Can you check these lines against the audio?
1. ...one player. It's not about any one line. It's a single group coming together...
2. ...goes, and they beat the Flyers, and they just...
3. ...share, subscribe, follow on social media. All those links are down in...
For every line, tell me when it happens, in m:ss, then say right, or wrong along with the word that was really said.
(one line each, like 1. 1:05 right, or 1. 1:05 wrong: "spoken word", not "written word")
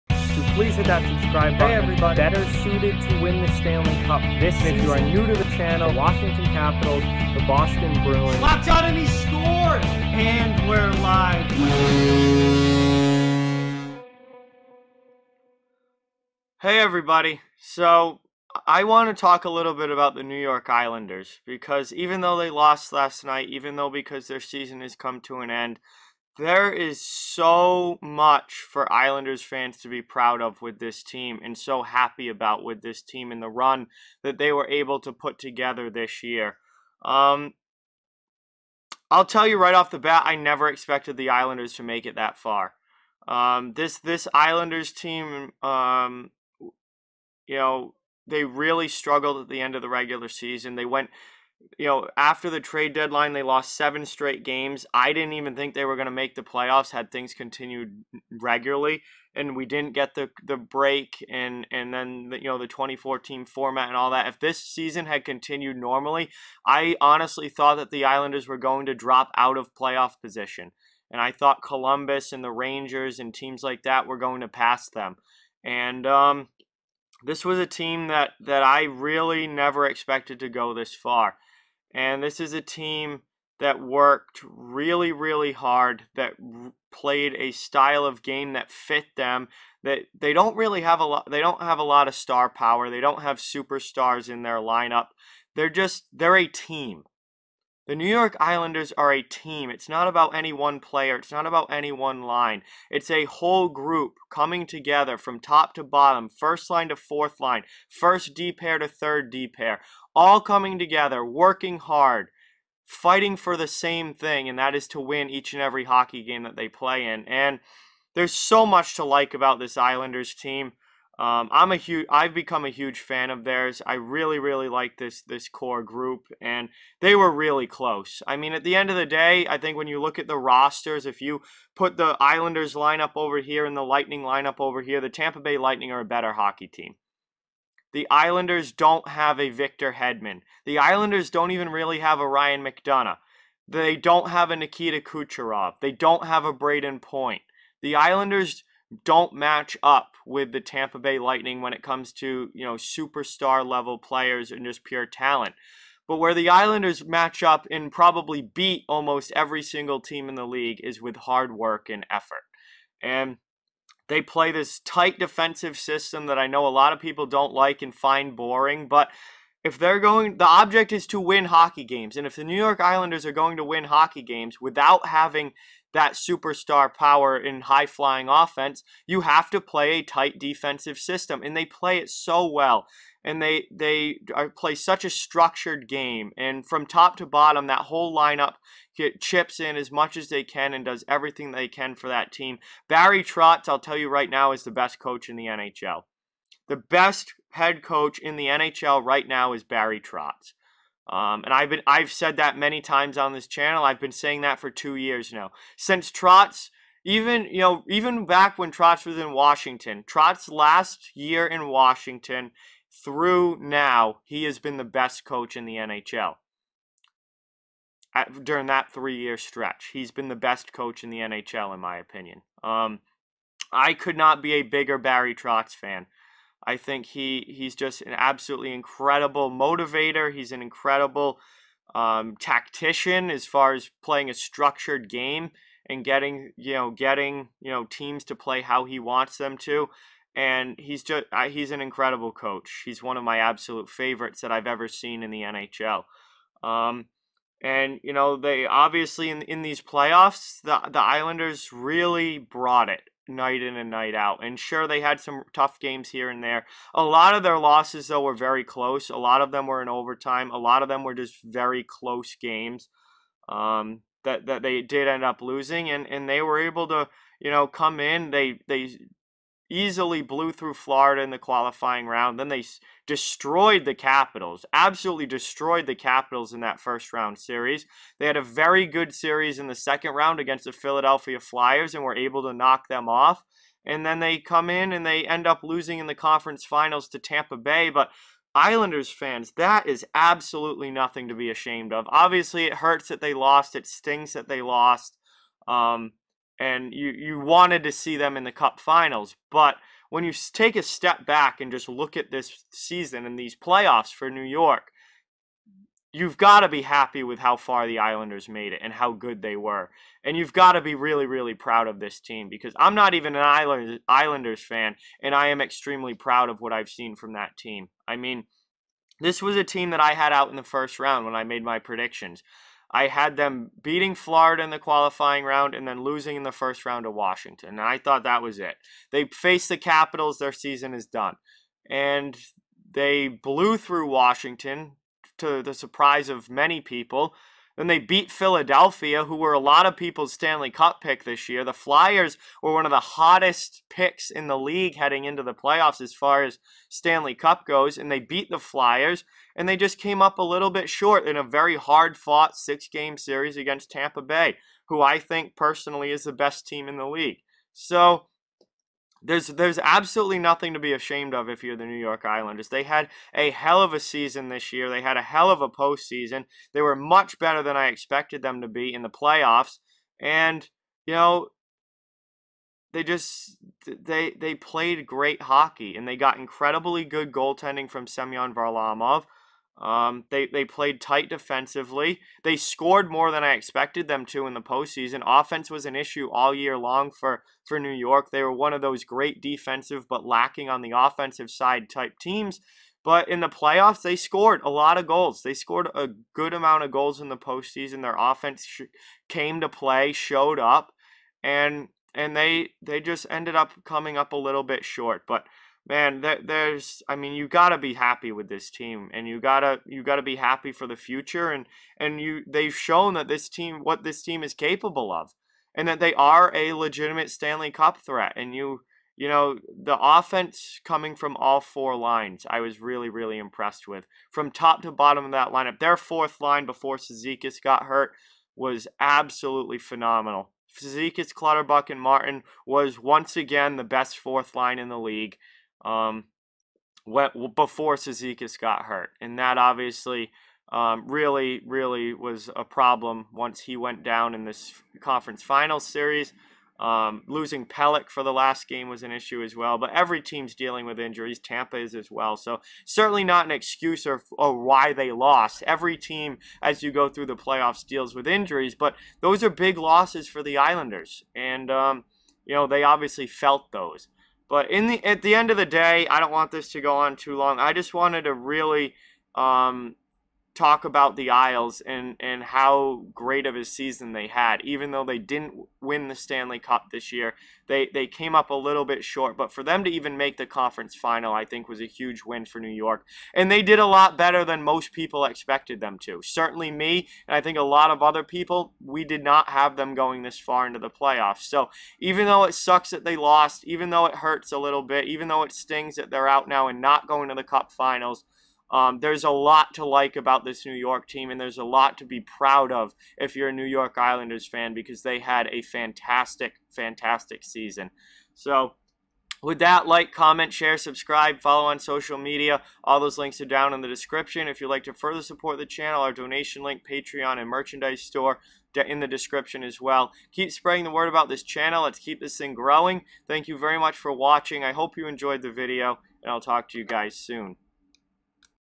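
1. 1:40 wrong: "whole", not "single"
2. 5:47 right
3. 8:30 right.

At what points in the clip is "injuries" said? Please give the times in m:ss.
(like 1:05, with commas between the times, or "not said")
7:30, 7:38.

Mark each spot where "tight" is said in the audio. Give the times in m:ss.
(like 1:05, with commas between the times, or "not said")
2:44, 3:00, 6:21.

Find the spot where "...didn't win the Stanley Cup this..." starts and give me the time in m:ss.
7:55.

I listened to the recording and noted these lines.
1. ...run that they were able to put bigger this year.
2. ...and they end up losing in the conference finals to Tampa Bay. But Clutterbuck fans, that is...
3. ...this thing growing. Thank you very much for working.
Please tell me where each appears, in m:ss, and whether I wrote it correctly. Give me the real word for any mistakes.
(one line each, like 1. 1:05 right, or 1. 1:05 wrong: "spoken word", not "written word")
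1. 0:33 wrong: "together", not "bigger"
2. 4:44 wrong: "Islanders", not "Clutterbuck"
3. 8:42 wrong: "watching", not "working".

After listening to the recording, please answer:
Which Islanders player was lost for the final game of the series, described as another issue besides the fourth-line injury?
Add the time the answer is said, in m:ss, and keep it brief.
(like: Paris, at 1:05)
Pelech, at 7:27.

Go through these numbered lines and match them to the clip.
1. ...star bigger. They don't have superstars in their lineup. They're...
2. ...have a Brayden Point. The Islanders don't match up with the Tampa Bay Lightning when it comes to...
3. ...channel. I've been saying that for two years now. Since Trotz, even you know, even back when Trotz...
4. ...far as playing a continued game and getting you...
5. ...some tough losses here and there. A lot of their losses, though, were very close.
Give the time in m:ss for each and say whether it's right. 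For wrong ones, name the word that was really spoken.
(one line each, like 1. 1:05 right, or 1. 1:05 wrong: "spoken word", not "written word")
1. 1:32 wrong: "power", not "bigger"
2. 2:26 right
3. 3:23 right
4. 3:53 wrong: "structured", not "continued"
5. 4:15 wrong: "games", not "losses".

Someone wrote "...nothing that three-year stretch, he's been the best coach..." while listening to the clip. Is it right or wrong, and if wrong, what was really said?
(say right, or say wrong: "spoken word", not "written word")
wrong: "during", not "nothing".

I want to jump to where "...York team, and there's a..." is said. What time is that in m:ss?
8:20.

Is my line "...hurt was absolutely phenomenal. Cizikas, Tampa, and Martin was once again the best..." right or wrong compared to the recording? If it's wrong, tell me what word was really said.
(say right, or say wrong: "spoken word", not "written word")
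wrong: "Clutterbuck", not "Tampa".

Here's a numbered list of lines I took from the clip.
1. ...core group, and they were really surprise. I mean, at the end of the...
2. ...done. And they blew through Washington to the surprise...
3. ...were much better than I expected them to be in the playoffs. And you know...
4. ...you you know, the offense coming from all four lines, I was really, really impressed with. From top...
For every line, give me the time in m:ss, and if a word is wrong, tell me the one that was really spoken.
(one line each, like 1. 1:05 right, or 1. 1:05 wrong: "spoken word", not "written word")
1. 2:05 wrong: "close", not "surprise"
2. 5:31 right
3. 6:06 right
4. 6:58 right.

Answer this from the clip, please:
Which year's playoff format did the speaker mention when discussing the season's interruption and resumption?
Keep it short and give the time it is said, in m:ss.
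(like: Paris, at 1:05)
2014, at 1:02.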